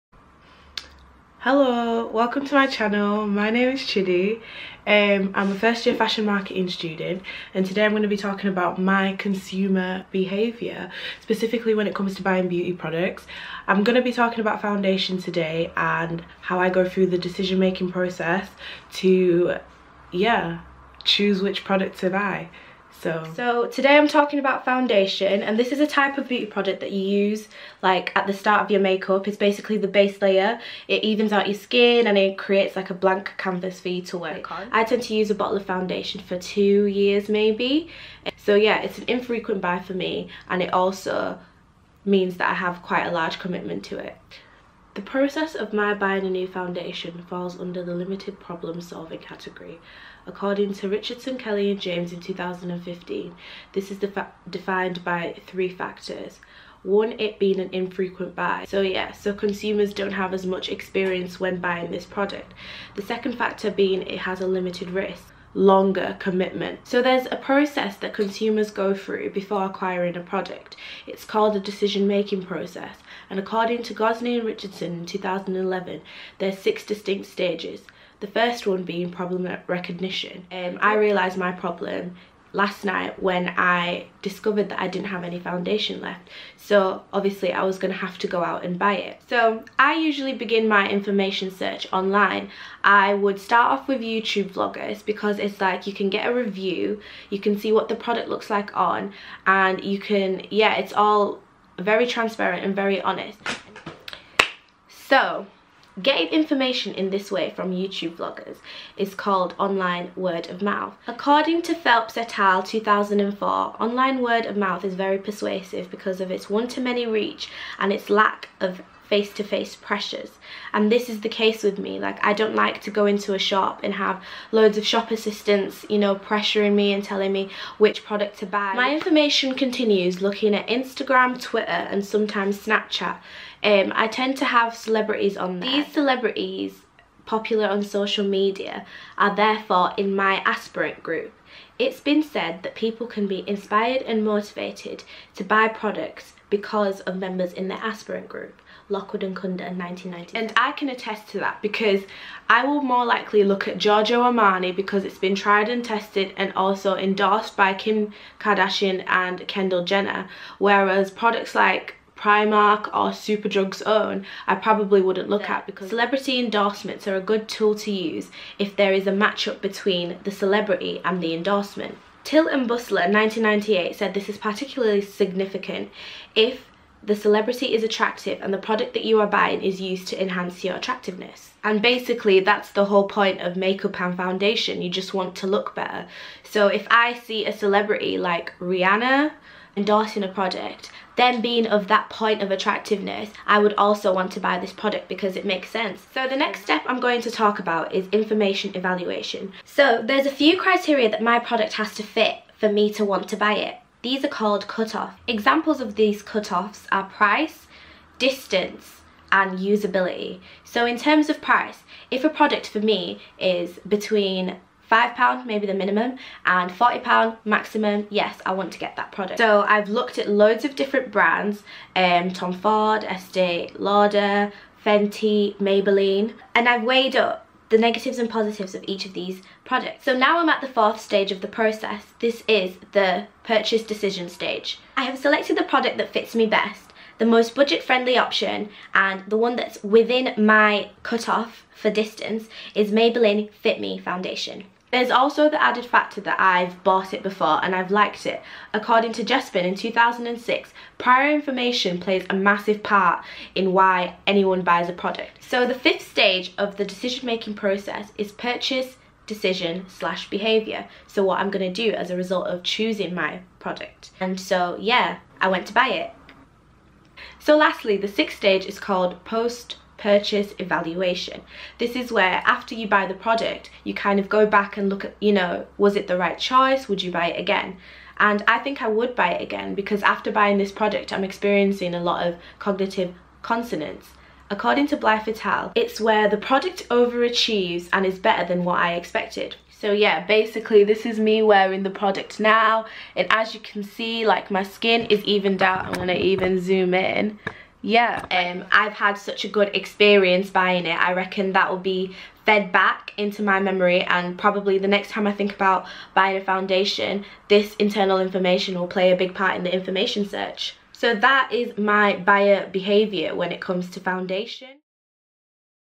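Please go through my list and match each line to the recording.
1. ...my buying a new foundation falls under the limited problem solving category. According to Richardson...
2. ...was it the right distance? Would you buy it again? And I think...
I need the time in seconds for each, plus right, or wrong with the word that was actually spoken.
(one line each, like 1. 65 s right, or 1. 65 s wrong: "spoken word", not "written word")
1. 45 s right
2. 275 s wrong: "choice", not "distance".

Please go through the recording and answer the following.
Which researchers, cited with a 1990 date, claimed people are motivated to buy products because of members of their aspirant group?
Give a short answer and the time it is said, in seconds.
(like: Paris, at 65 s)
Lockwood and Kunda, at 148 s.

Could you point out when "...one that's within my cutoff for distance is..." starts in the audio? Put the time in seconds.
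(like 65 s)
239 s.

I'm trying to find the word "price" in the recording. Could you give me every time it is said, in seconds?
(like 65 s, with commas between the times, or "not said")
207 s, 211 s.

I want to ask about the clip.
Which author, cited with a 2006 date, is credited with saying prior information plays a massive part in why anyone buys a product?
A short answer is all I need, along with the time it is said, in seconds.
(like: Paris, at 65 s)
Jepsen, at 249 s.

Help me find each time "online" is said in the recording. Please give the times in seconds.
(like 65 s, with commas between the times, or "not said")
91 s, 109 s, 113 s.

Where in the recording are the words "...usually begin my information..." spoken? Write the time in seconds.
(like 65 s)
89 s.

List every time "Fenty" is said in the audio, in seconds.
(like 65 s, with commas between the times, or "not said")
224 s.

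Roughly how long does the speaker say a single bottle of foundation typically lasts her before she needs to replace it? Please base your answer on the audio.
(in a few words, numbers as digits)
2 years.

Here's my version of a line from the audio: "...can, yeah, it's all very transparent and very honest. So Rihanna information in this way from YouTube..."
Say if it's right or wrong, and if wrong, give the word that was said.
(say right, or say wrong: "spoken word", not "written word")
wrong: "Getting", not "Rihanna".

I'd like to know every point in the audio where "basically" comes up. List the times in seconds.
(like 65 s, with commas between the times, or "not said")
29 s, 181 s, 290 s.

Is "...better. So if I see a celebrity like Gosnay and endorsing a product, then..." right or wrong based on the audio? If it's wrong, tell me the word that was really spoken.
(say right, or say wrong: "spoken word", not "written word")
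wrong: "Rihanna", not "Gosnay".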